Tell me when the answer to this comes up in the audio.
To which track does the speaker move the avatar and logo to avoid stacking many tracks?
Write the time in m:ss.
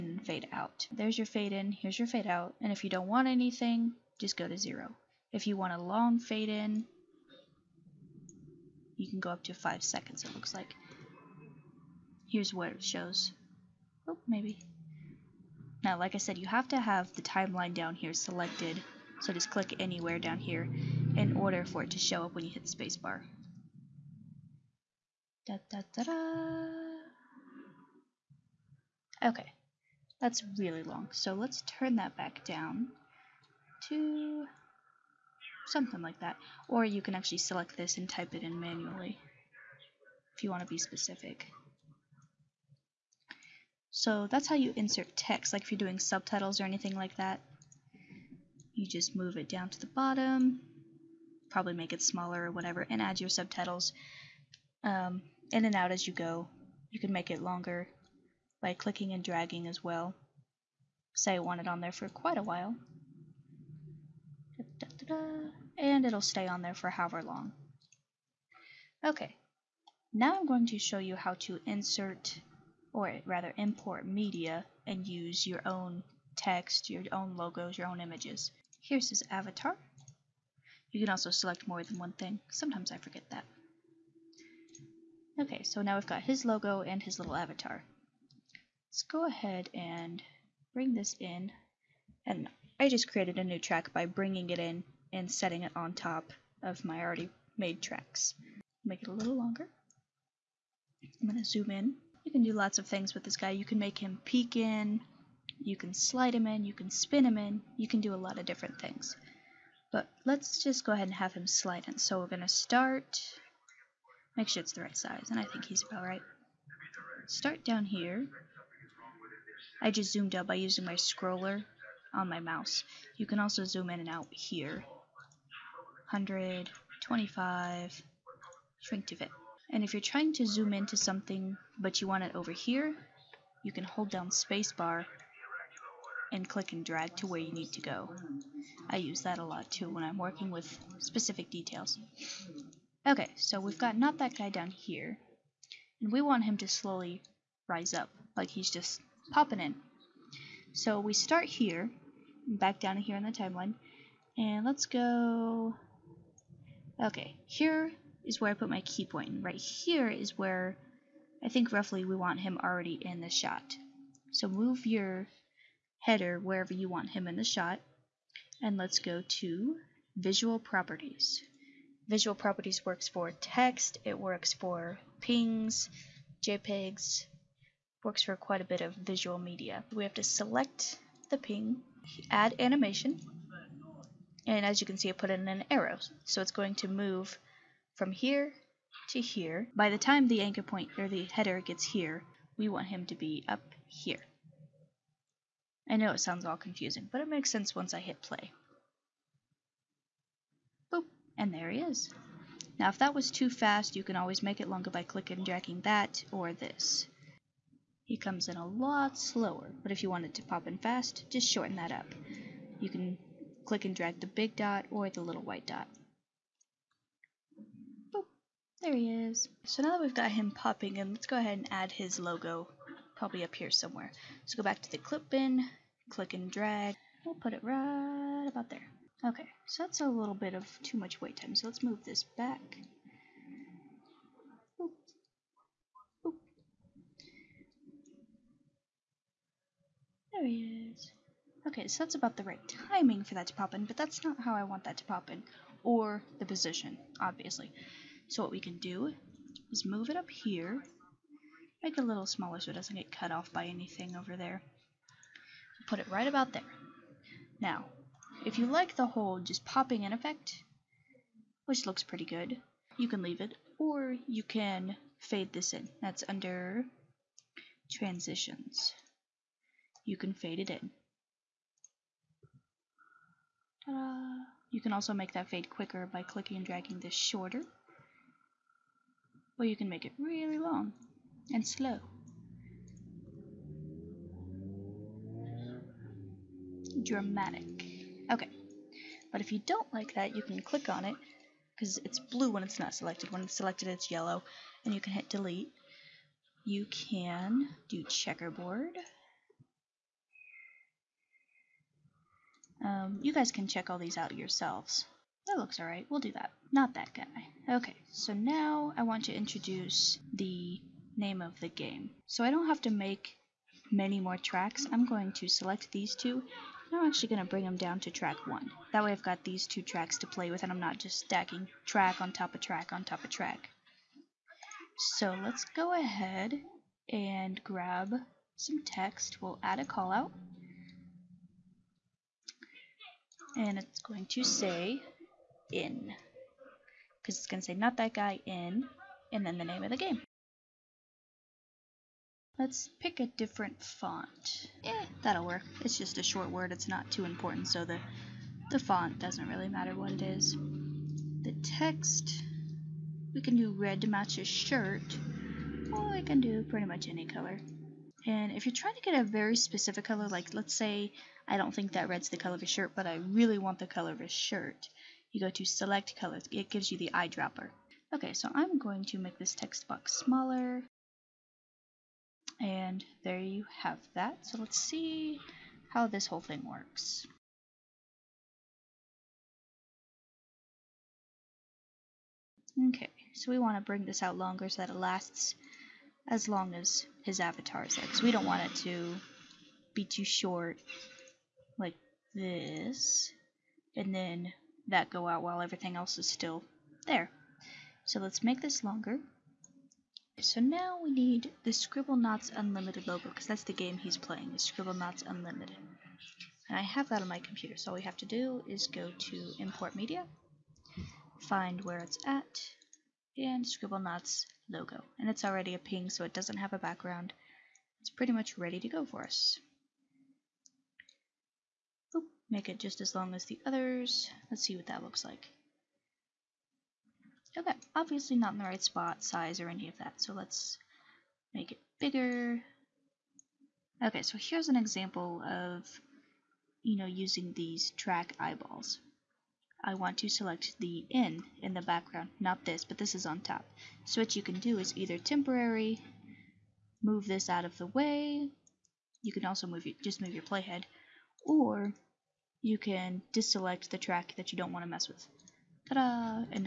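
5:18.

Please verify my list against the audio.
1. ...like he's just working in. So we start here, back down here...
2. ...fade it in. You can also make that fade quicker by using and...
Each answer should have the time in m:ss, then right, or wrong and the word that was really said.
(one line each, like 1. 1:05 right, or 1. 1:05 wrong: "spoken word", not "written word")
1. 2:28 wrong: "popping", not "working"
2. 4:30 wrong: "clicking", not "using".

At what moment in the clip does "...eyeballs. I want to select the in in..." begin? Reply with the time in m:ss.
7:18.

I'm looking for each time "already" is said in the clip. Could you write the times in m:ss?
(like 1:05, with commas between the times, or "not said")
1:37, 2:42, 6:55.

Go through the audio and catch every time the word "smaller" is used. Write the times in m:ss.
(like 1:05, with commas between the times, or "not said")
0:52, 4:12, 6:10.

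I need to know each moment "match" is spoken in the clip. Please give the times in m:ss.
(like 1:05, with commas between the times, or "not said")
5:54.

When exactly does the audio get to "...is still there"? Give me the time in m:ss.
6:36.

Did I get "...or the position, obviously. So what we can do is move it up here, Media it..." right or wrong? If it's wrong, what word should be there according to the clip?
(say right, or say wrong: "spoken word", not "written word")
wrong: "Make", not "Media".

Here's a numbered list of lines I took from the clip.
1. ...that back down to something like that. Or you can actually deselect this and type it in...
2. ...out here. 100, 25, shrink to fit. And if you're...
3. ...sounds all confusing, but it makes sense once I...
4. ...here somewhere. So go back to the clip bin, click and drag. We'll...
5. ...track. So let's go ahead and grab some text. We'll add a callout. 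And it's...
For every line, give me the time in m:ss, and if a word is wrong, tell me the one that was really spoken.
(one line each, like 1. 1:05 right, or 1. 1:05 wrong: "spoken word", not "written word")
1. 0:31 wrong: "select", not "deselect"
2. 2:04 right
3. 3:16 right
4. 3:43 right
5. 5:23 right.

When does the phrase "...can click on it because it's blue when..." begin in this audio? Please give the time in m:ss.
4:50.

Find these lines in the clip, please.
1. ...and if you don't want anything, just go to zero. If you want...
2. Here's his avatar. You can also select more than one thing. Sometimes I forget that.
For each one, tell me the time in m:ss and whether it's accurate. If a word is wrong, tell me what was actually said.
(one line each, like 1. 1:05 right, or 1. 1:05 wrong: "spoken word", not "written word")
1. 0:02 right
2. 1:18 right.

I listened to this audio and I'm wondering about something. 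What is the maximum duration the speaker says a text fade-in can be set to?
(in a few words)
5 seconds.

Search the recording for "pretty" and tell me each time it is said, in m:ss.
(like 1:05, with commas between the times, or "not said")
4:22, 5:56, 6:58.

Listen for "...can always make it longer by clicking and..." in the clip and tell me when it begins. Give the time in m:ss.
3:24.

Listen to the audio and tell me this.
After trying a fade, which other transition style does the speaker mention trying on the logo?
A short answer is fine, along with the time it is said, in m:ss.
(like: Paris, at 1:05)
Checkerboard, at 4:58.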